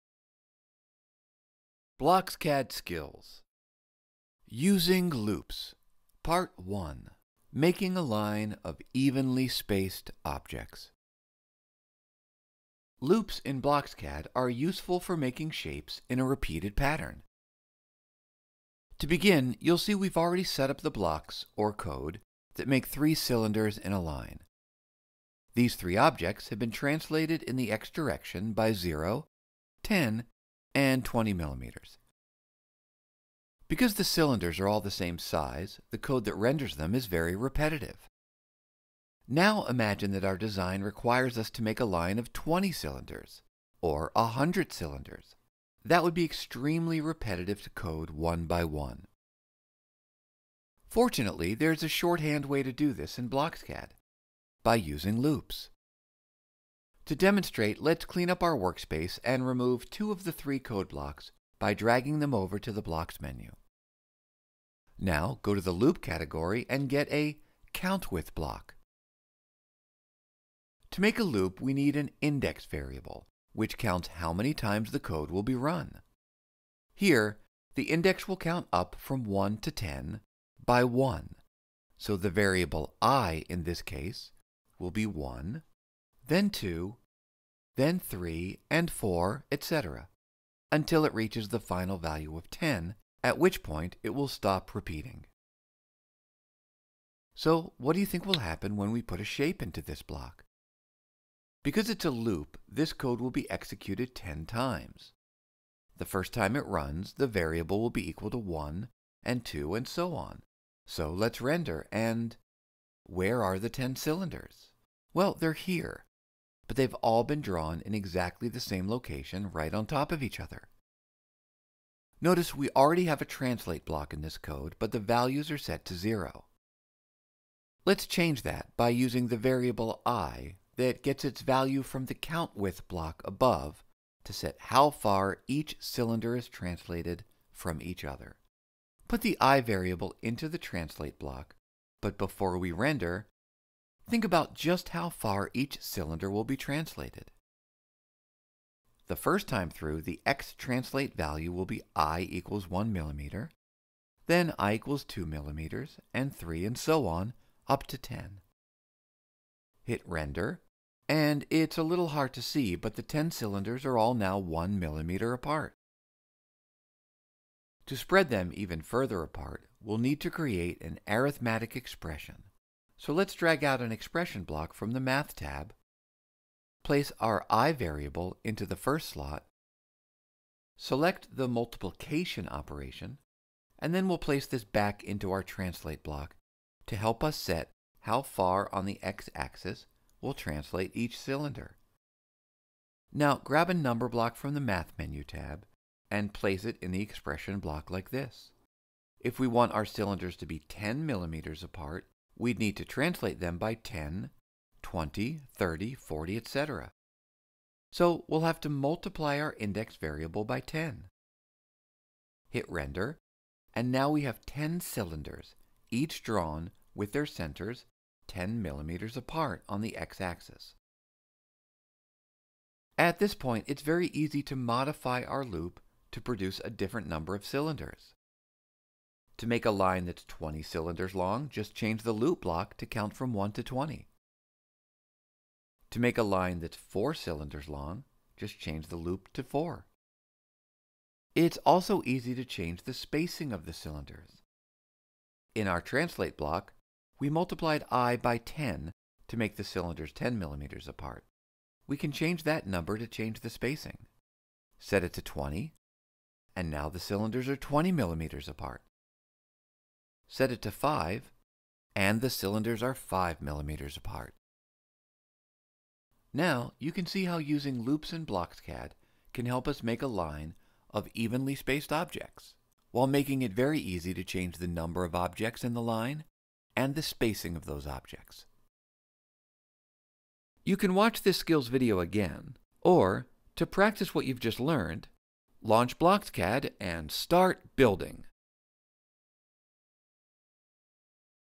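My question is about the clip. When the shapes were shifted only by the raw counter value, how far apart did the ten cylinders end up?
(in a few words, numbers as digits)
1 millimeter.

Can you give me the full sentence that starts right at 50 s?
Fortunately, there is a shorthand way to do this in BlocksCAD, by using loops.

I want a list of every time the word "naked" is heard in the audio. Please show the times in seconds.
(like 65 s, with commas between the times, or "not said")
not said.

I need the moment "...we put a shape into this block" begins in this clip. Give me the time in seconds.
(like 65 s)
98 s.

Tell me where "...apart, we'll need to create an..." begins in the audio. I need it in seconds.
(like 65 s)
169 s.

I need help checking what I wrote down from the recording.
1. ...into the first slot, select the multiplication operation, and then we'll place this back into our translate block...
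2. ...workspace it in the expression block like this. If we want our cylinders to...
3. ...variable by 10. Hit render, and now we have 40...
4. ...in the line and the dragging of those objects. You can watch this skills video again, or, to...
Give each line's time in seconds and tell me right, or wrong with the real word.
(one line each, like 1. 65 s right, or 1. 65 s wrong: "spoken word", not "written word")
1. 178 s right
2. 196 s wrong: "place", not "workspace"
3. 209 s wrong: "10", not "40"
4. 275 s wrong: "spacing", not "dragging".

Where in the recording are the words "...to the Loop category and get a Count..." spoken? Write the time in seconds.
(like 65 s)
65 s.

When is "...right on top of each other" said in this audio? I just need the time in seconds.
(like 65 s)
119 s.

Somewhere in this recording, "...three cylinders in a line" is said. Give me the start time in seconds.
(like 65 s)
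22 s.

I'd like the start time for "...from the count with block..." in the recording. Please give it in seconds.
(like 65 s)
131 s.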